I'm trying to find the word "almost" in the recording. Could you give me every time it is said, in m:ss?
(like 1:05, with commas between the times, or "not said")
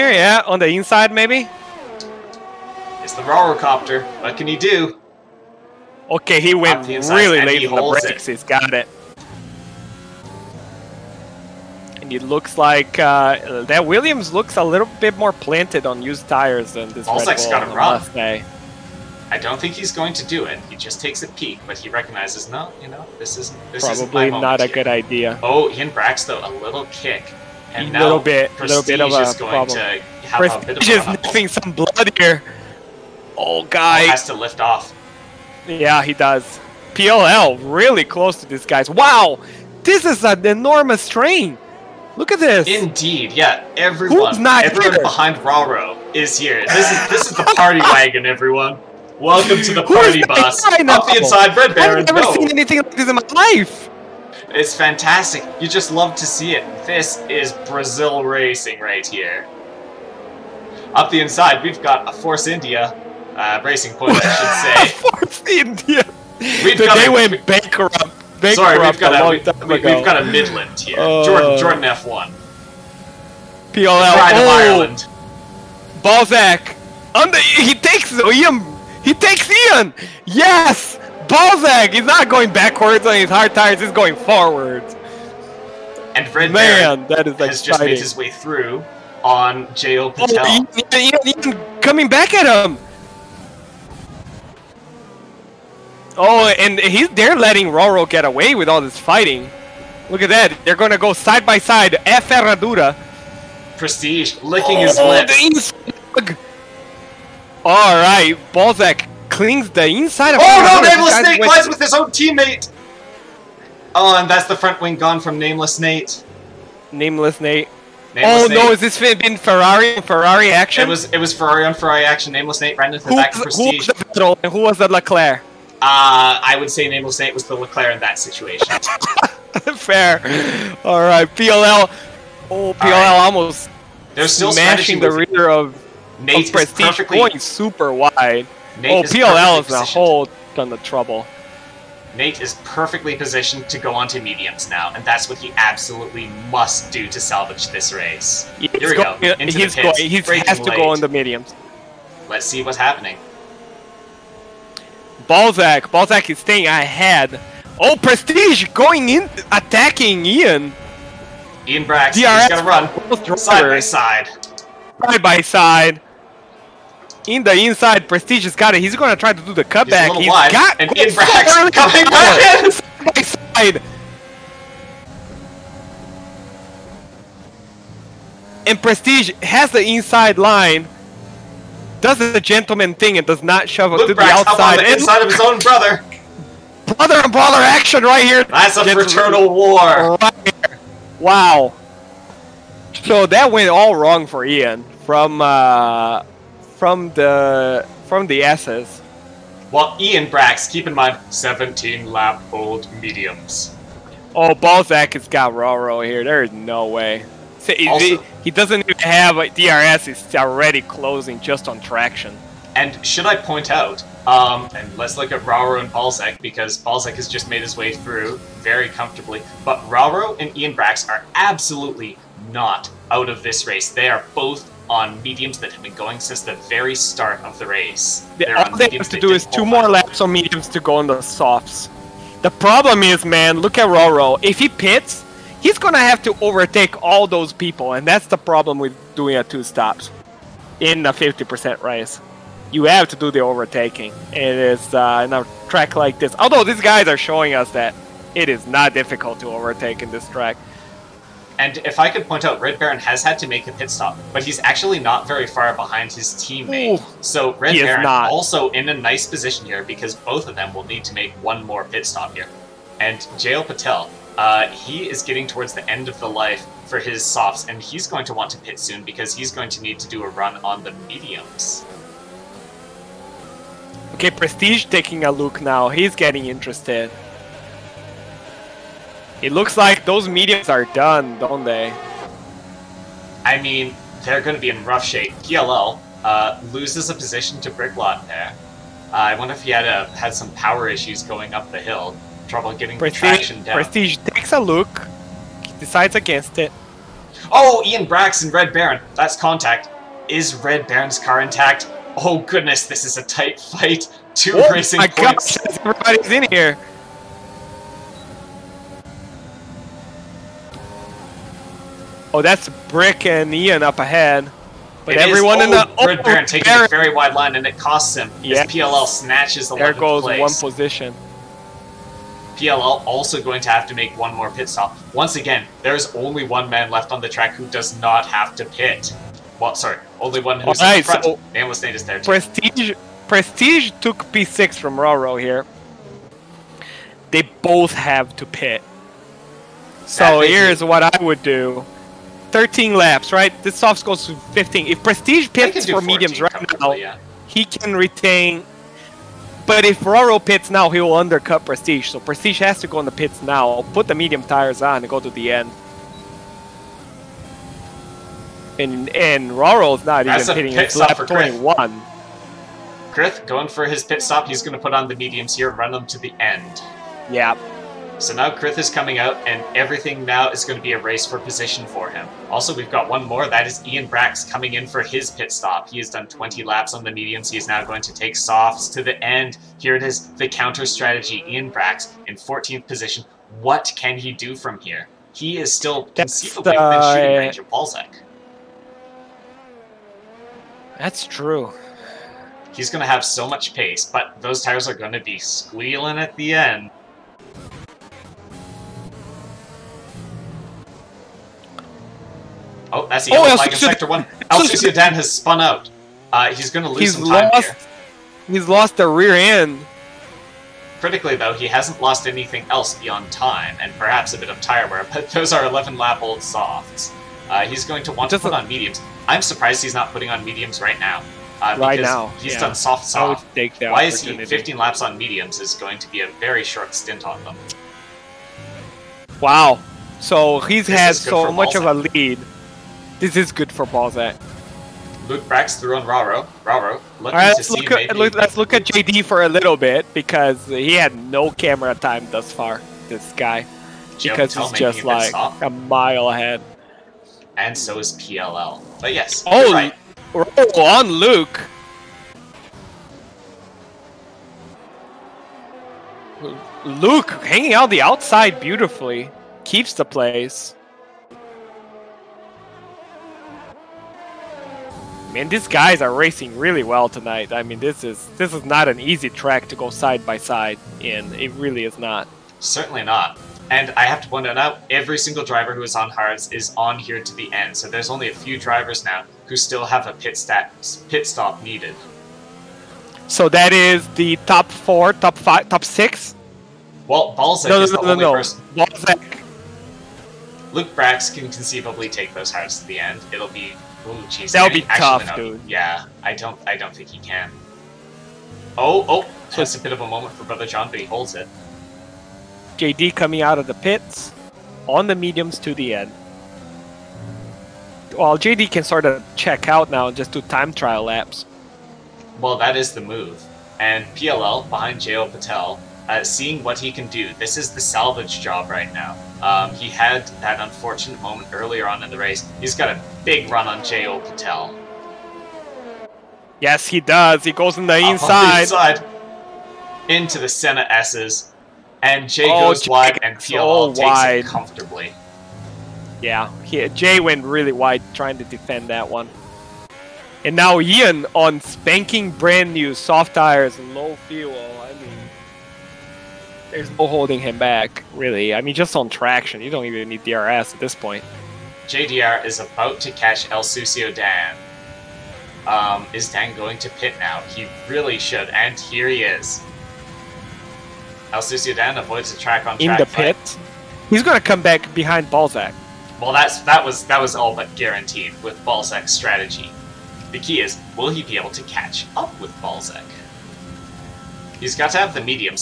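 0:17, 2:13.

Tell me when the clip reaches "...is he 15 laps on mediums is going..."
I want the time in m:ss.
7:04.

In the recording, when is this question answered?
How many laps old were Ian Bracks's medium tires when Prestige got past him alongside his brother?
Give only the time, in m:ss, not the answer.
3:21.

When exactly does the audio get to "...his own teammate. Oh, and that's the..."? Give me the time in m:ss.
1:51.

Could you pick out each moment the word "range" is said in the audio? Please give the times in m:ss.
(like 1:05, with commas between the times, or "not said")
6:27.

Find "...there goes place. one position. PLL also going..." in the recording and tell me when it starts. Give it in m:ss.
5:19.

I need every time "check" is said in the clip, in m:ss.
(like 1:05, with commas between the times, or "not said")
8:29.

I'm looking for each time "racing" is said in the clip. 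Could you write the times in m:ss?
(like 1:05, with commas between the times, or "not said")
0:58, 1:03, 5:04, 7:46.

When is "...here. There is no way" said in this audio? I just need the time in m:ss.
3:26.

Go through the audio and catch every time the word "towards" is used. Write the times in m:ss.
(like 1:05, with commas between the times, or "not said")
4:25.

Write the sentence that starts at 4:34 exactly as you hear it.
Okay, Prestige taking a look now.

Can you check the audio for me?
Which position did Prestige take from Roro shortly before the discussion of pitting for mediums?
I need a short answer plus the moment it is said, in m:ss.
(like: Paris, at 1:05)
P6, at 5:34.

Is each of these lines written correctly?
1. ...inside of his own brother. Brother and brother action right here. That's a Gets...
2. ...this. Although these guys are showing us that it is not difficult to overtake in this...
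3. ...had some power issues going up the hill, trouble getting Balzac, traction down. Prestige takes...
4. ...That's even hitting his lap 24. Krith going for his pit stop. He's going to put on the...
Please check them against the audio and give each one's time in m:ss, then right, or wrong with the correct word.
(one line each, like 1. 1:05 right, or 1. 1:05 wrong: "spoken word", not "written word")
1. 3:04 right
2. 4:06 right
3. 4:50 wrong: "Prestige", not "Balzac"
4. 6:00 wrong: "21", not "24".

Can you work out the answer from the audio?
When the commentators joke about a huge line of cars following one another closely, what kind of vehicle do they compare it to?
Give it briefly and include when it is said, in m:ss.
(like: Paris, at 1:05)
Party bus, at 0:49.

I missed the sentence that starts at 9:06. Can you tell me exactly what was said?
There's no holding him back, really.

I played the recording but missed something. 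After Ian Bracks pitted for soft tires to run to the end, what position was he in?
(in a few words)
14th.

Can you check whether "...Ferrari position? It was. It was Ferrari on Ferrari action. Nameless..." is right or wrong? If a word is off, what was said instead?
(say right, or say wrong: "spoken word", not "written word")
wrong: "action", not "position".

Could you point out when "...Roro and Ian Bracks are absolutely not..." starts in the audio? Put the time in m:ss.
3:39.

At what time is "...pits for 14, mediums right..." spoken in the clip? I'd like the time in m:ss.
5:45.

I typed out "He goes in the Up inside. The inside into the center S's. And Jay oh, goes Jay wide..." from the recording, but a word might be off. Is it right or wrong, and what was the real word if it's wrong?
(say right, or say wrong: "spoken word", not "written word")
right.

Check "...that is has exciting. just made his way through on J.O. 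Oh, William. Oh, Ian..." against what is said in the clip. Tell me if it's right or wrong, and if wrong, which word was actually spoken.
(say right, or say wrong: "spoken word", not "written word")
wrong: "Patel", not "William".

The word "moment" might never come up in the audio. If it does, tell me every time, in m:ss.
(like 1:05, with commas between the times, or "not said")
8:20, 8:41.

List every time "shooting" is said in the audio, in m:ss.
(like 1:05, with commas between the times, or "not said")
6:27.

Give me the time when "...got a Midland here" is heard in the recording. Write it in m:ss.
1:10.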